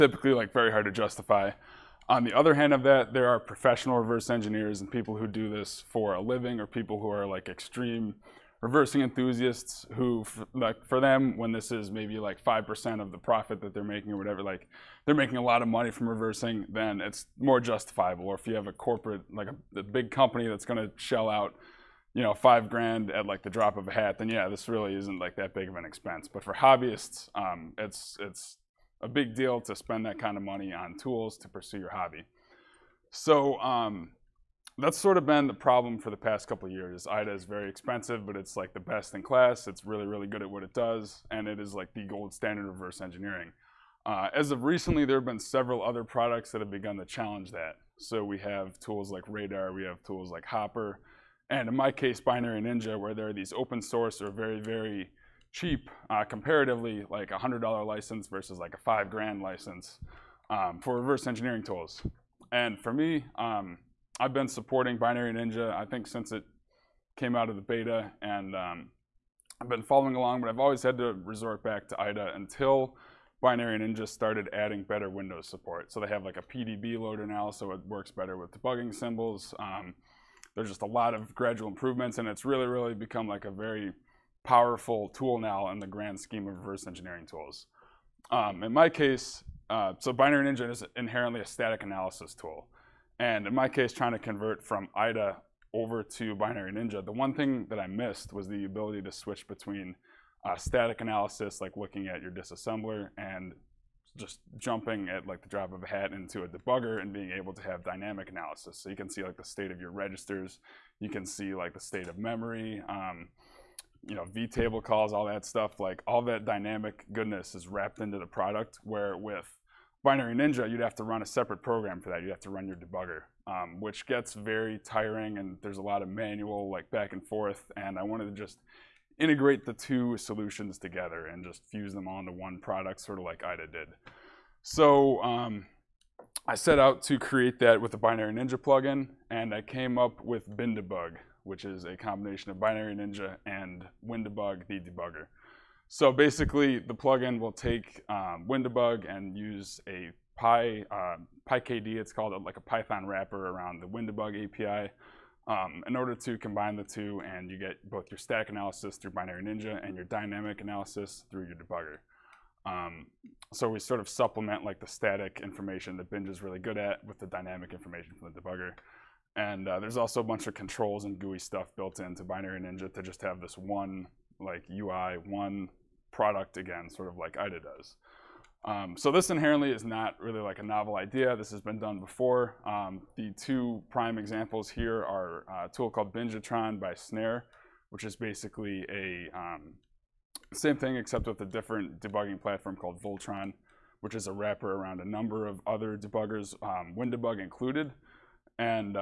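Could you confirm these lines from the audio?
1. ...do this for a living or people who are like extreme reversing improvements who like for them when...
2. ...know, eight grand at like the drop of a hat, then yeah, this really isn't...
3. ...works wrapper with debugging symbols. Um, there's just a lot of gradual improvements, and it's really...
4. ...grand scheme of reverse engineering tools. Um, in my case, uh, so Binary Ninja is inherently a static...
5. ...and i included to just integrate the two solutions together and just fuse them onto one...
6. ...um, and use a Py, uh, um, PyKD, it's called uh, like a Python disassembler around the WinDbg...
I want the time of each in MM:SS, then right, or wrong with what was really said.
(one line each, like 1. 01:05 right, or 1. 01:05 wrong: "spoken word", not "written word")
1. 00:05 wrong: "enthusiasts", not "improvements"
2. 00:22 wrong: "five", not "eight"
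3. 01:17 wrong: "better", not "wrapper"
4. 01:25 right
5. 02:07 wrong: "wanted", not "included"
6. 02:28 wrong: "wrapper", not "disassembler".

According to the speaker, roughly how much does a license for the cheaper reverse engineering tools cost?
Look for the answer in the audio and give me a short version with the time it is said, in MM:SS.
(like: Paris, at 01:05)
$100, at 00:57.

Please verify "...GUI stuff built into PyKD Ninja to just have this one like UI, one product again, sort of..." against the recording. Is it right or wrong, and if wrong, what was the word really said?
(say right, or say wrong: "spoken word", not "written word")
wrong: "Binary", not "PyKD".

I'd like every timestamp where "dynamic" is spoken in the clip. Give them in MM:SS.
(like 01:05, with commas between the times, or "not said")
01:47, 01:56, 02:40, 02:47.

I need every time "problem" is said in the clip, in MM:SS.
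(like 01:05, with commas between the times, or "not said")
00:35.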